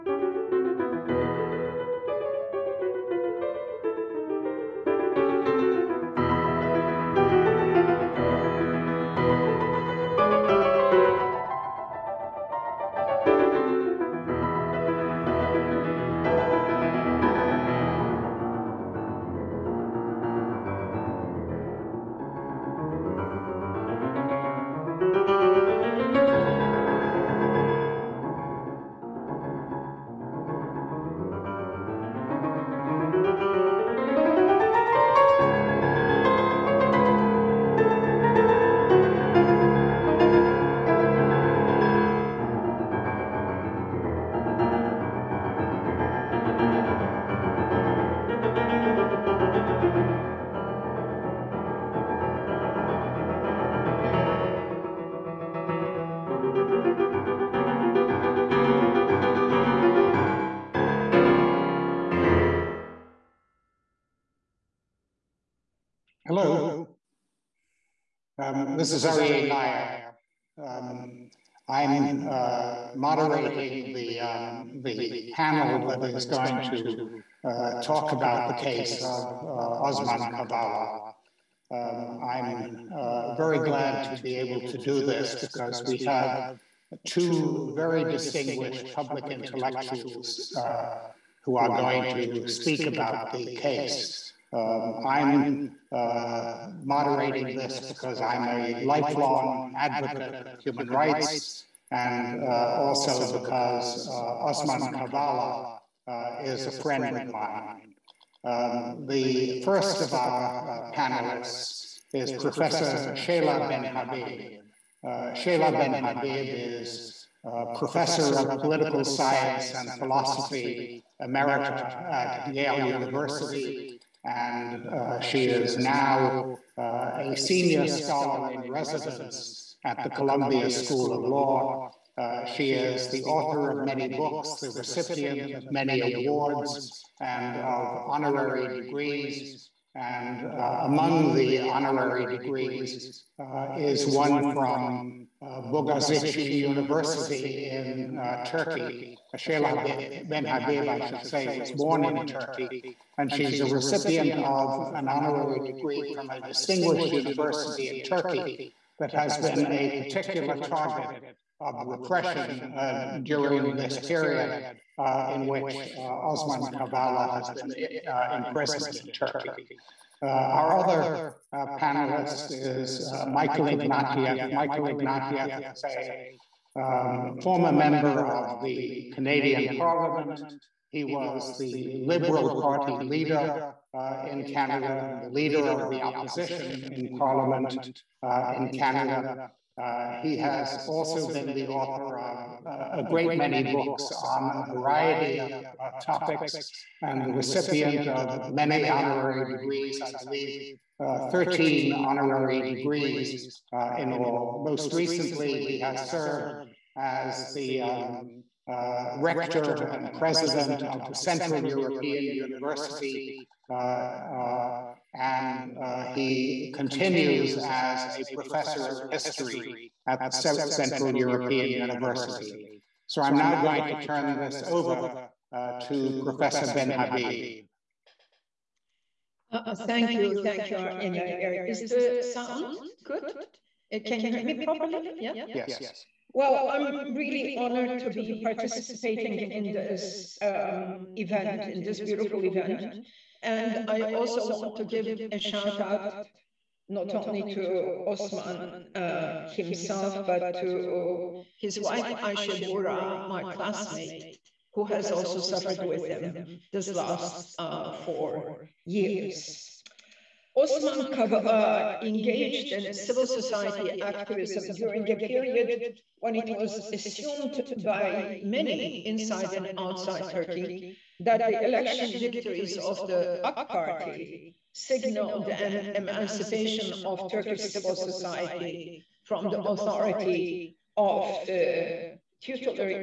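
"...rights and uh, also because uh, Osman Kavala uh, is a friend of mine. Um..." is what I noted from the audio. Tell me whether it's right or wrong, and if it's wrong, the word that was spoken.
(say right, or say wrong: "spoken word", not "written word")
right.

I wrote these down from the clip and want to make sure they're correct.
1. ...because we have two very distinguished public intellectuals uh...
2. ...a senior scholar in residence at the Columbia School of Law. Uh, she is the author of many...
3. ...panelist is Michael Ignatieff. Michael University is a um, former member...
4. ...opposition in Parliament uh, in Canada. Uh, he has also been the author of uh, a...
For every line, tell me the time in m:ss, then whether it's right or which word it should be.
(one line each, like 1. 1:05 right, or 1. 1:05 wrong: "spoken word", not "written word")
1. 1:25 right
2. 2:07 right
3. 2:51 wrong: "Ignatieff", not "University"
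4. 3:06 right.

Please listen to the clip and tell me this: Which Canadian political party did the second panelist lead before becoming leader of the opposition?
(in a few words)
Liberal Party.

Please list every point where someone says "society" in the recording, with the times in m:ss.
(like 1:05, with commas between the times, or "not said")
4:23, 4:37.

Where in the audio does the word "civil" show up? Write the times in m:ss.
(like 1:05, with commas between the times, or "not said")
4:22, 4:37.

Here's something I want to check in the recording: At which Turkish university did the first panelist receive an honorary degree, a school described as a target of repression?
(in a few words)
Bogazici University.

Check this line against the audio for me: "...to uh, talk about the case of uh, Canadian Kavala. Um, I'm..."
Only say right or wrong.
wrong.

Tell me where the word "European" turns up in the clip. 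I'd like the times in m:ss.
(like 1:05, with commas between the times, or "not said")
3:31, 3:41.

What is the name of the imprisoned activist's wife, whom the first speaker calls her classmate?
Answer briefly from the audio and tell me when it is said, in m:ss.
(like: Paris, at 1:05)
Aisha, at 4:12.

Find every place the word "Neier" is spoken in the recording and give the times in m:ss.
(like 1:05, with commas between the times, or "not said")
1:09.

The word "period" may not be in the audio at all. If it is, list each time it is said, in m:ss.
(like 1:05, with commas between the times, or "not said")
2:44, 4:25.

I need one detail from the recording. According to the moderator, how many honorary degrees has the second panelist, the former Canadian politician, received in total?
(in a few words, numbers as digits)
13.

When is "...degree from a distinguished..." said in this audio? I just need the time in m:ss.
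2:35.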